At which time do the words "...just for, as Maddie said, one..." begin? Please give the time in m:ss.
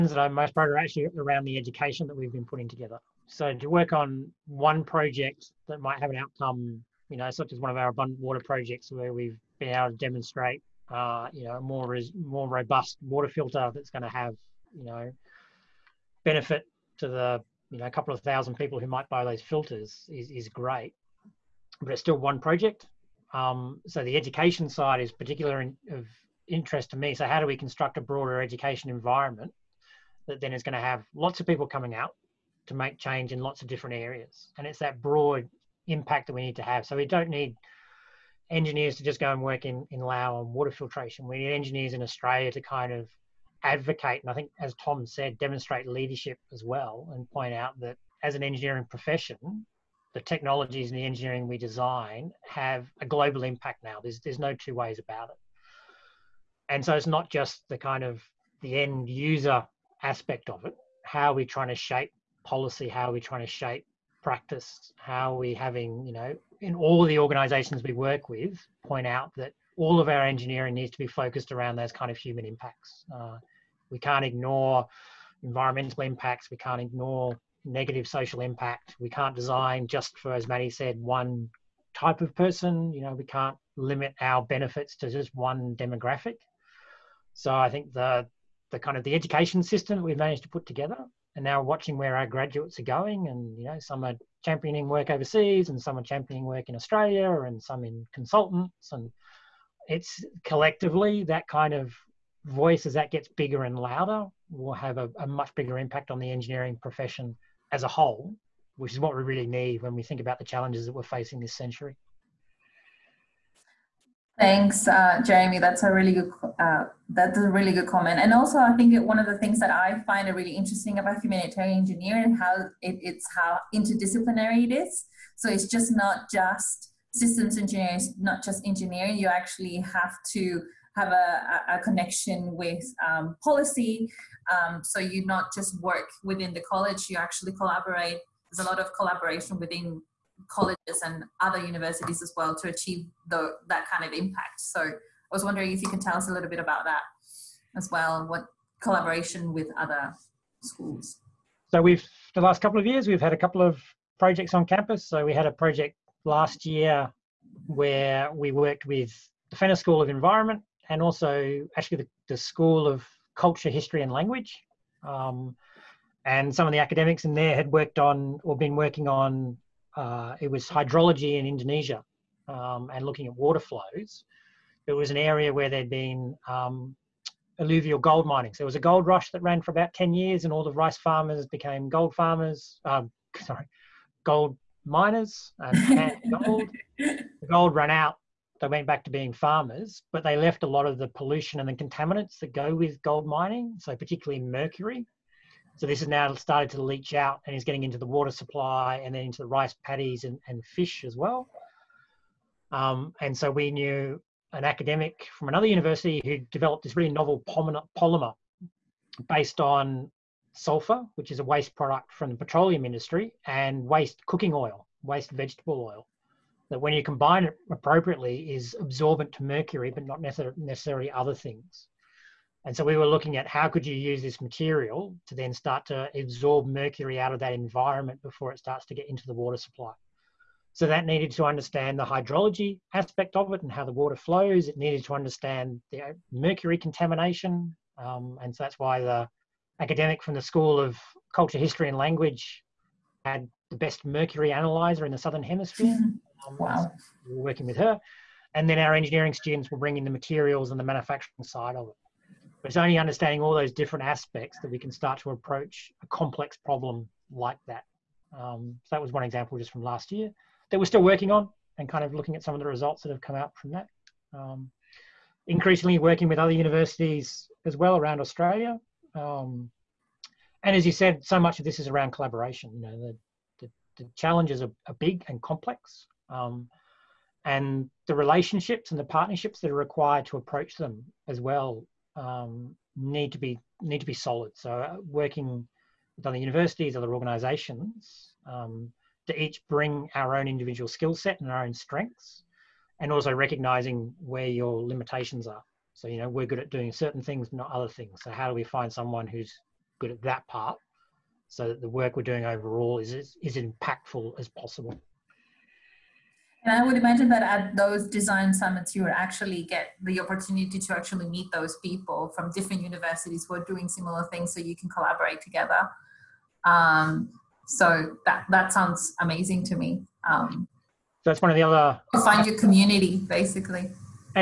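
1:19.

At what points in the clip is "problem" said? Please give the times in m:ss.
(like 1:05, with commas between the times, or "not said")
4:16.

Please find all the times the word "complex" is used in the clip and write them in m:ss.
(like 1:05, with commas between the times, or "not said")
4:16, 4:35.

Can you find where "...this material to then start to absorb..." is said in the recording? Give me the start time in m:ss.
3:44.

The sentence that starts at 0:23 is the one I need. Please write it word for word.
Um, so the education side is particular in, of interest to me.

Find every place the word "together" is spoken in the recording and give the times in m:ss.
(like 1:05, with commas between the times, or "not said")
0:02, 1:30, 5:15.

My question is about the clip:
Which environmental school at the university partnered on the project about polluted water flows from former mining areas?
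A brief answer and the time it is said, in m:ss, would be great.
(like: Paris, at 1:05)
Fenner School of Environment, at 2:39.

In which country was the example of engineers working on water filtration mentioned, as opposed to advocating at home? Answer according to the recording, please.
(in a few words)
Lao.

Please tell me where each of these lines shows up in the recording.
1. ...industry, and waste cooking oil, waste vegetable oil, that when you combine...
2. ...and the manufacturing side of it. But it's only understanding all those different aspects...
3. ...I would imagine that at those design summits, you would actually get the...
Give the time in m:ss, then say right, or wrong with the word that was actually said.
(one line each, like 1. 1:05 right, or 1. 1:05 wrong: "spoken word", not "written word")
1. 3:32 right
2. 4:10 right
3. 5:06 right.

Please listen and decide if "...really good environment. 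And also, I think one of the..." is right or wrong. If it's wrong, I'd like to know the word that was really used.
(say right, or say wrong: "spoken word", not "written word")
wrong: "comment", not "environment".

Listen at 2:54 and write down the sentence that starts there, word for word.
It was an area where there'd been um, alluvial gold mining.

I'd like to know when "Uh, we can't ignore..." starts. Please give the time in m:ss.
1:13.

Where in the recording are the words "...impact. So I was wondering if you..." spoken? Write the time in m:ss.
2:24.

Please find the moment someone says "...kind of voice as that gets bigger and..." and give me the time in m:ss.
1:41.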